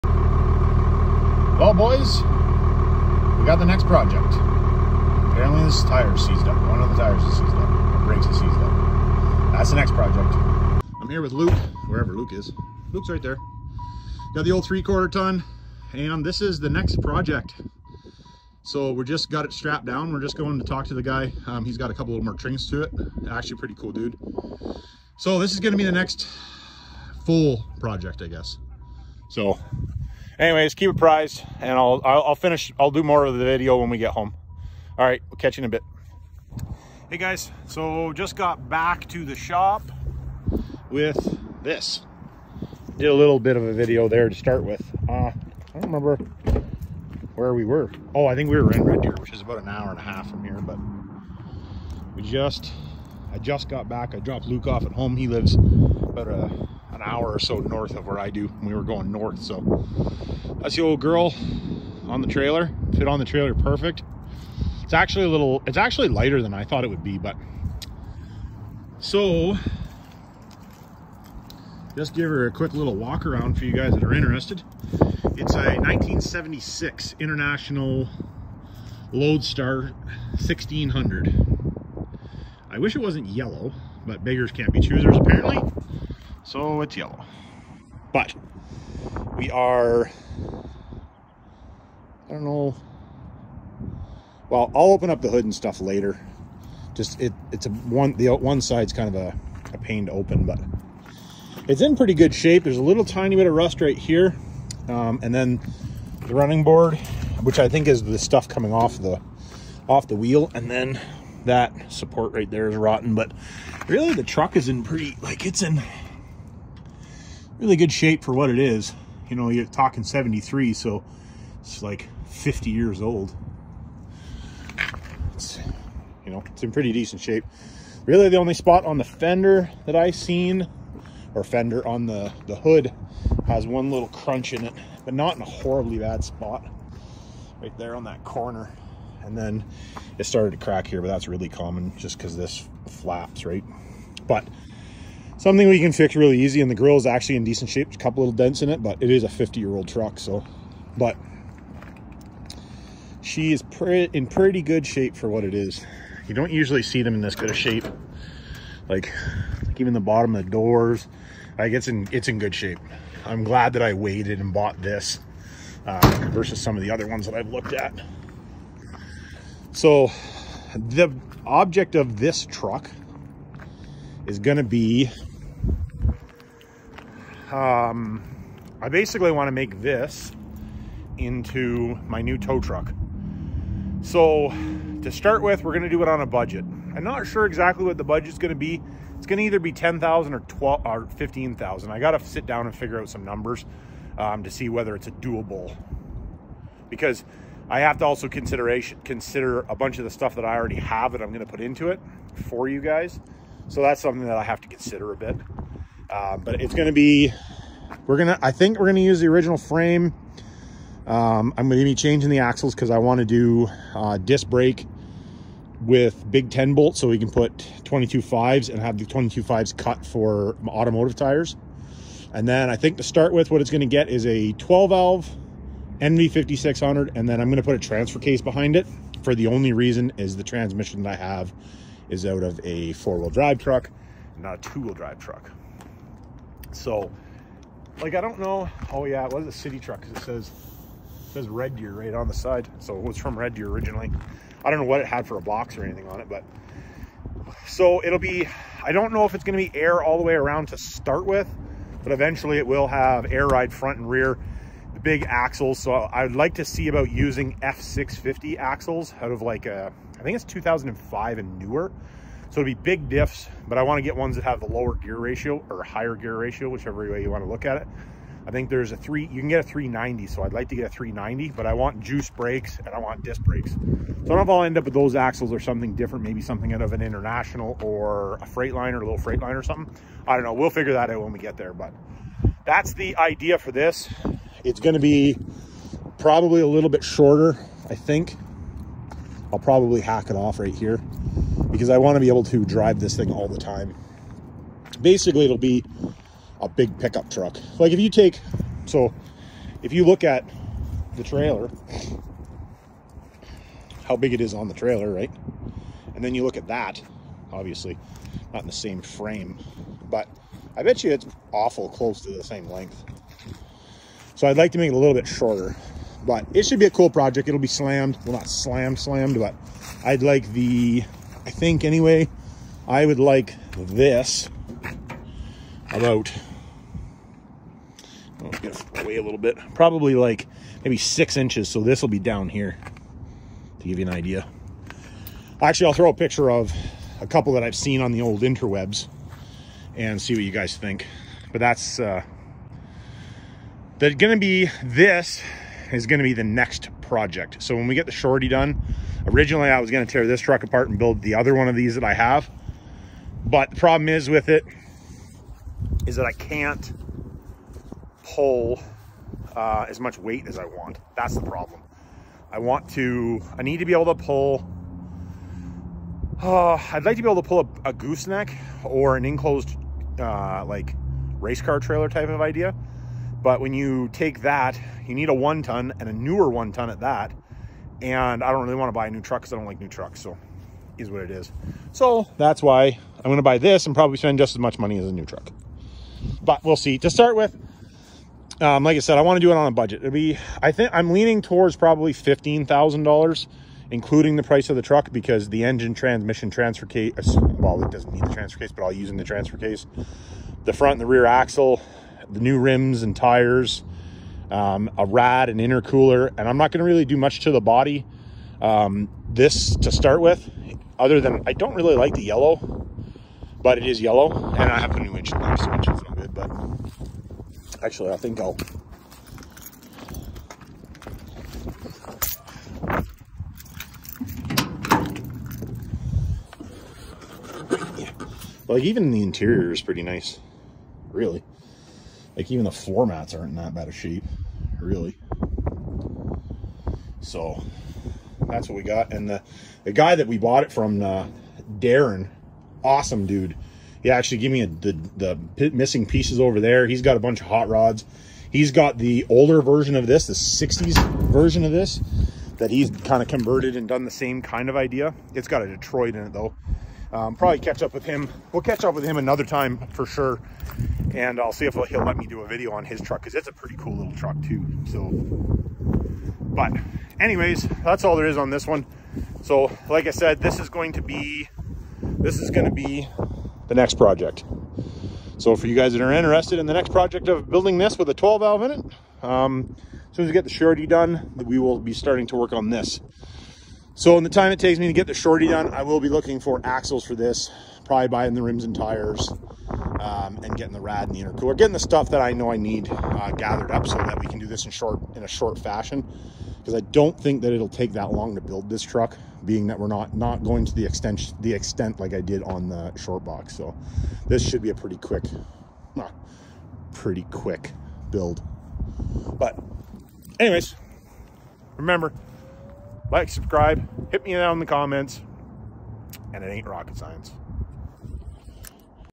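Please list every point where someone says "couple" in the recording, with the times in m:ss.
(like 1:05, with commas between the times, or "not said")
0:21, 2:27, 5:37.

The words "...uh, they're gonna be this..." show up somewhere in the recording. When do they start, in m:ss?
5:41.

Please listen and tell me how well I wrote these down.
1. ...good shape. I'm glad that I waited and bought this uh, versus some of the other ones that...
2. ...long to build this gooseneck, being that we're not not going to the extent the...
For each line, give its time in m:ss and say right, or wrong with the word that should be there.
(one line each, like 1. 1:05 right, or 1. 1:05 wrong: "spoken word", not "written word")
1. 2:42 right
2. 8:18 wrong: "truck", not "gooseneck".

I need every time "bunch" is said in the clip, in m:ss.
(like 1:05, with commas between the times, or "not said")
3:19, 7:27.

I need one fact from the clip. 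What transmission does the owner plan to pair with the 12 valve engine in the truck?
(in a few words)
NV5600.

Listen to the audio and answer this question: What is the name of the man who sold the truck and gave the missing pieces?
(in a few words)
Darren.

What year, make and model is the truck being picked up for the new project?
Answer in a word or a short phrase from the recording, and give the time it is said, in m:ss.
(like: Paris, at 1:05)
1976 International Loadstar 1600, at 1:15.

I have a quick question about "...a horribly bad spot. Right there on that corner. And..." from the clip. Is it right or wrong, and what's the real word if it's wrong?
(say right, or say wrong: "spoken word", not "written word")
right.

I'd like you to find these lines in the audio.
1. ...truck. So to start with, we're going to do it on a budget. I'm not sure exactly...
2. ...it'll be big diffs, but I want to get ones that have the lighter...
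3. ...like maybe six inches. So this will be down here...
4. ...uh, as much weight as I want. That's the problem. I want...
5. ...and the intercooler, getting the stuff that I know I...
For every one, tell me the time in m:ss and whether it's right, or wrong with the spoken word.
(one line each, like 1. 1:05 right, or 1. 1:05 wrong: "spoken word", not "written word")
1. 3:02 right
2. 4:22 wrong: "lower", not "lighter"
3. 5:30 right
4. 5:59 right
5. 8:11 right.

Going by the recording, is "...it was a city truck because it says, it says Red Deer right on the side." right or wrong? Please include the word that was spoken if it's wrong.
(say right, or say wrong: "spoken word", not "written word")
right.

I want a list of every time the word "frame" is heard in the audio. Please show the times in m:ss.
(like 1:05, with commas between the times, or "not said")
3:29, 5:09.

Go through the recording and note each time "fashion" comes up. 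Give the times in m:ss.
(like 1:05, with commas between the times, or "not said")
8:15.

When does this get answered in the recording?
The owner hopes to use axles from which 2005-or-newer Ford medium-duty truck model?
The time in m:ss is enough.
4:17.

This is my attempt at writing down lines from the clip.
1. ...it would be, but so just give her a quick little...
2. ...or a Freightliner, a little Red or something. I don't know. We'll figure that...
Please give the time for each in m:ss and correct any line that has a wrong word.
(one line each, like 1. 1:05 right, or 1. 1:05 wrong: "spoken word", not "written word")
1. 1:06 right
2. 4:37 wrong: "Freightliner", not "Red".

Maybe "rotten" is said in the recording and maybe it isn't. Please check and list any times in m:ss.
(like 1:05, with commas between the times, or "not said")
1:52.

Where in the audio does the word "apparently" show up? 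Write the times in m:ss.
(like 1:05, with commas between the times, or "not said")
0:05, 1:25.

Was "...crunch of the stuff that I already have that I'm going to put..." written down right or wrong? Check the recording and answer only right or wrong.
wrong.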